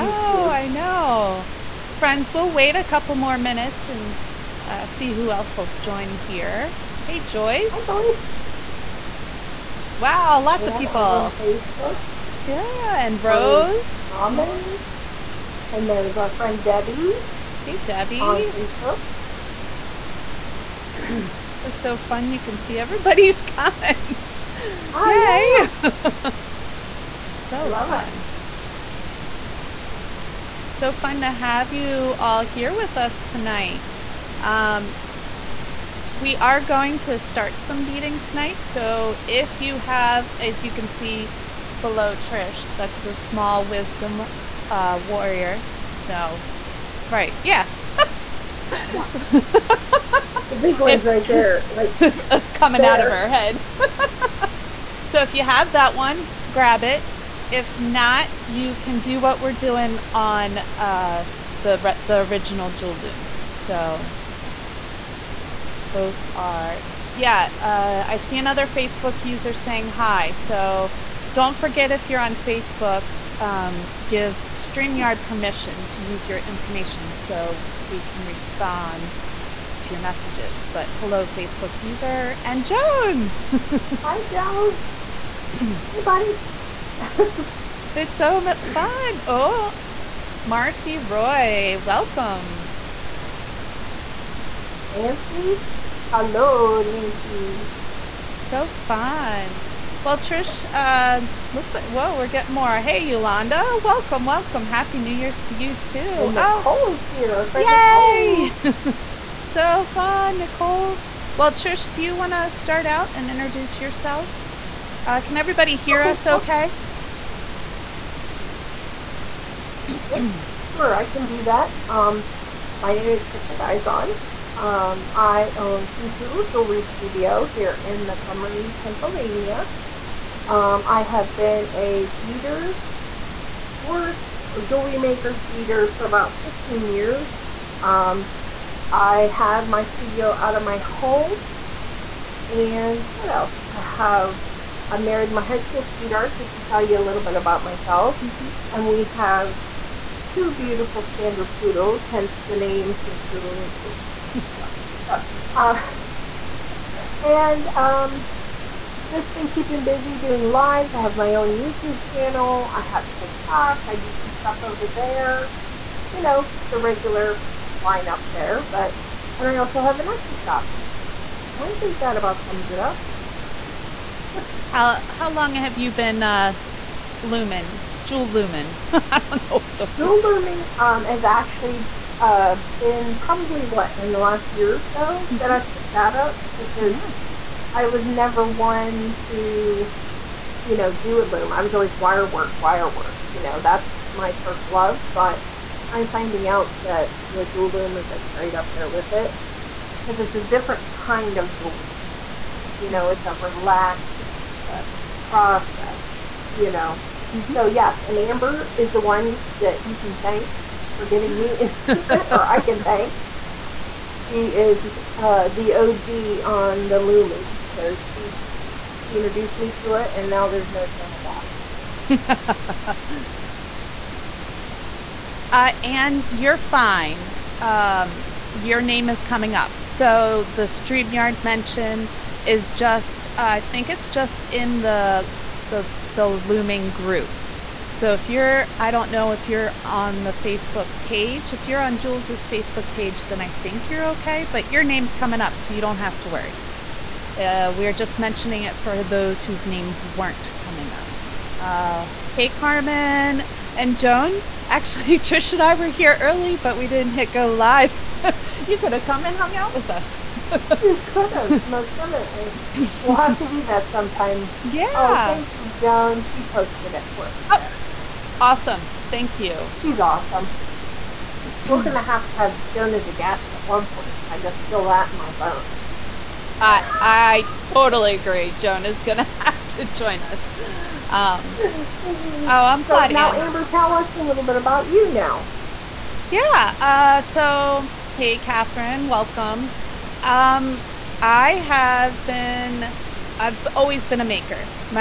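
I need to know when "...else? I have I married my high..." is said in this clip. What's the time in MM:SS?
02:23.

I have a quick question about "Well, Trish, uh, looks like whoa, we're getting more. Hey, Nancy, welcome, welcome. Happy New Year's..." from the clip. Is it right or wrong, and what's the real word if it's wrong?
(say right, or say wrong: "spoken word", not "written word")
wrong: "Yolanda", not "Nancy".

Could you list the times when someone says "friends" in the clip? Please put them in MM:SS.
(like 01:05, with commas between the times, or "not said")
00:01, 00:16.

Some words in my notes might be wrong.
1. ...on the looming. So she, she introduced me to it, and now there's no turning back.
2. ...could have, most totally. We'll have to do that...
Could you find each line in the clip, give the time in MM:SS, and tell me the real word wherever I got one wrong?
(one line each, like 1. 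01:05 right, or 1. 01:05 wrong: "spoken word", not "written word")
1. 03:36 right
2. 04:21 wrong: "definitely", not "totally".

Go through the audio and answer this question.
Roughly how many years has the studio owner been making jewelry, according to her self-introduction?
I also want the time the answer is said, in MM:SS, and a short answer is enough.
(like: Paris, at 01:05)
15, at 02:16.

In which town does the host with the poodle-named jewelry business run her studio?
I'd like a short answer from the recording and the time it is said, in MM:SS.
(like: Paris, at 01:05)
Montgomery, Pennsylvania, at 02:08.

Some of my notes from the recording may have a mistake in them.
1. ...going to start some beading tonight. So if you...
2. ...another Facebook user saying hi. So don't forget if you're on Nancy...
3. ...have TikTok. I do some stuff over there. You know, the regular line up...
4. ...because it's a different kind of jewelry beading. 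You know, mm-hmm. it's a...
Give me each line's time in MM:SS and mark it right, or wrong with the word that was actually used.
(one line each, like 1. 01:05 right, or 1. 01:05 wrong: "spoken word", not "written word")
1. 00:36 right
2. 01:08 wrong: "Facebook", not "Nancy"
3. 02:42 right
4. 03:20 wrong: "making", not "beading".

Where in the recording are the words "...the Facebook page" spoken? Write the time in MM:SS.
04:00.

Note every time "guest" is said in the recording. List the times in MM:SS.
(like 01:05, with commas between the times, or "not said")
04:33.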